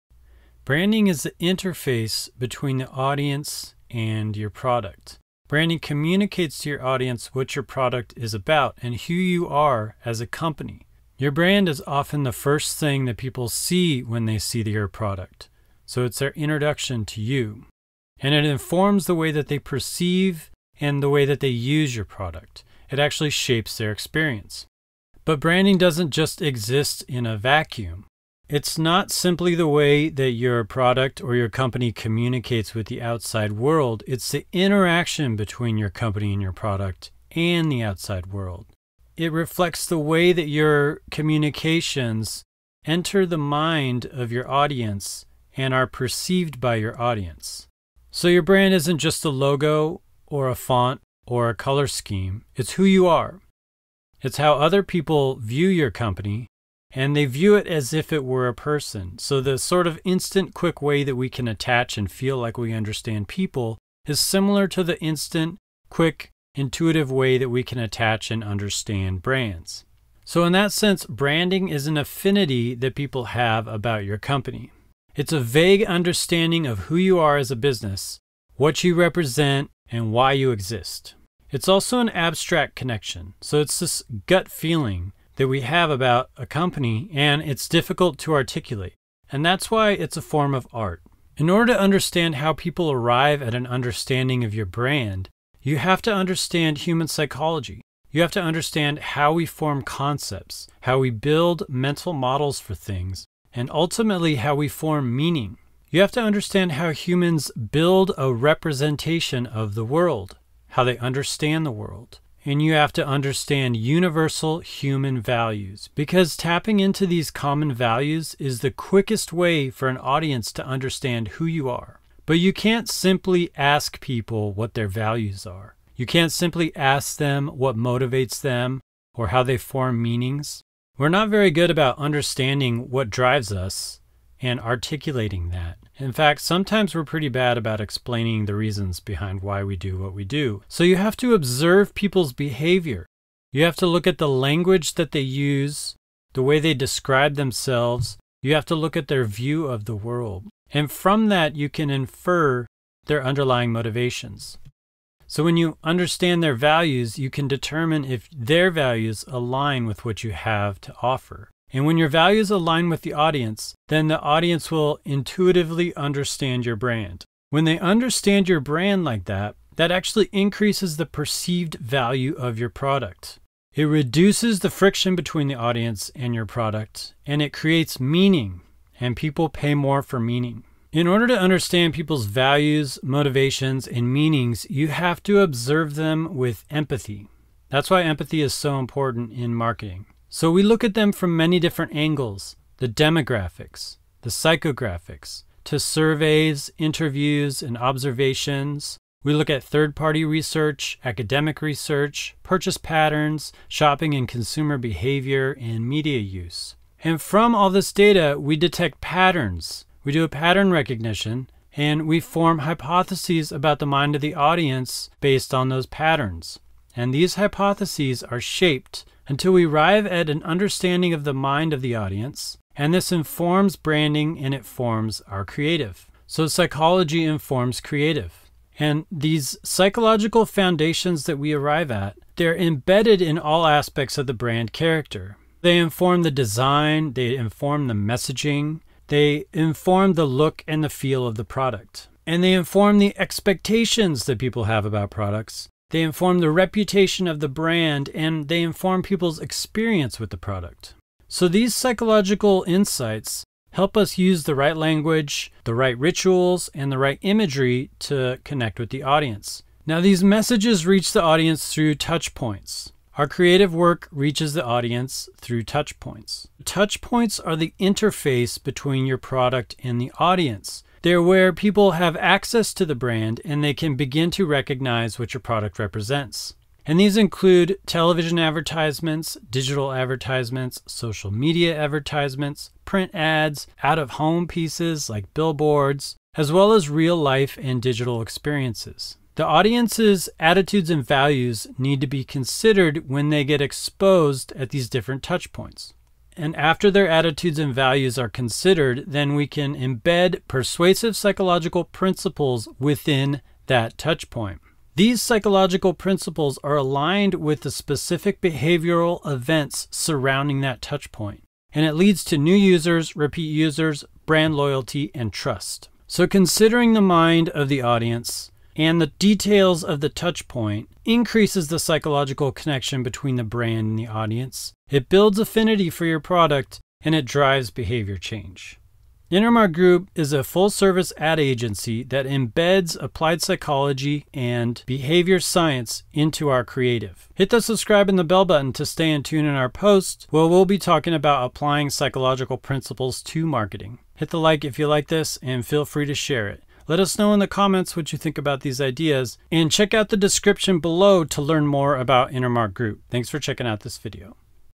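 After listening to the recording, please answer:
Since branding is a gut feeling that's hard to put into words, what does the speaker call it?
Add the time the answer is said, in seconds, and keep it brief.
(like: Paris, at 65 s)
A form of art, at 90 s.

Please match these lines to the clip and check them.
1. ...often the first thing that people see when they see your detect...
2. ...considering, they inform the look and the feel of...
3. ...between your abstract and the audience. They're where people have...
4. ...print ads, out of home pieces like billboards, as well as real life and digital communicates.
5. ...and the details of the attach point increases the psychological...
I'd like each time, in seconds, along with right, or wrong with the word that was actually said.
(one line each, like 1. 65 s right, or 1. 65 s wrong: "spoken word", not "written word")
1. 11 s wrong: "product", not "detect"
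2. 237 s wrong: "messaging", not "considering"
3. 268 s wrong: "product", not "abstract"
4. 282 s wrong: "experiences", not "communicates"
5. 318 s wrong: "touch", not "attach".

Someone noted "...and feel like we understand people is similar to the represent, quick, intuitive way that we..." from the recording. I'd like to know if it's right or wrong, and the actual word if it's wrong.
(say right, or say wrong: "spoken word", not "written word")
wrong: "instant", not "represent".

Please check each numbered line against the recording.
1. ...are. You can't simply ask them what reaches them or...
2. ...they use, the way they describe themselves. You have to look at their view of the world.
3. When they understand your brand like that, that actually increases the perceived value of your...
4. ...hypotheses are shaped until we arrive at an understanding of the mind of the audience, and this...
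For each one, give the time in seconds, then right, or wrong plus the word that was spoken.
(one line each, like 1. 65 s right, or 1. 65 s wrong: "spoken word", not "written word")
1. 125 s wrong: "motivates", not "reaches"
2. 145 s right
3. 167 s right
4. 217 s right.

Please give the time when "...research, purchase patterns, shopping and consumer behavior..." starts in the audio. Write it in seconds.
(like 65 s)
201 s.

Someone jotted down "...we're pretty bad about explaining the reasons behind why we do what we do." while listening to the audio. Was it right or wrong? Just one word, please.
right.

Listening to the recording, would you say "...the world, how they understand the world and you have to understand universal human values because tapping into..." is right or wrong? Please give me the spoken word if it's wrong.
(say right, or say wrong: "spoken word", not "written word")
right.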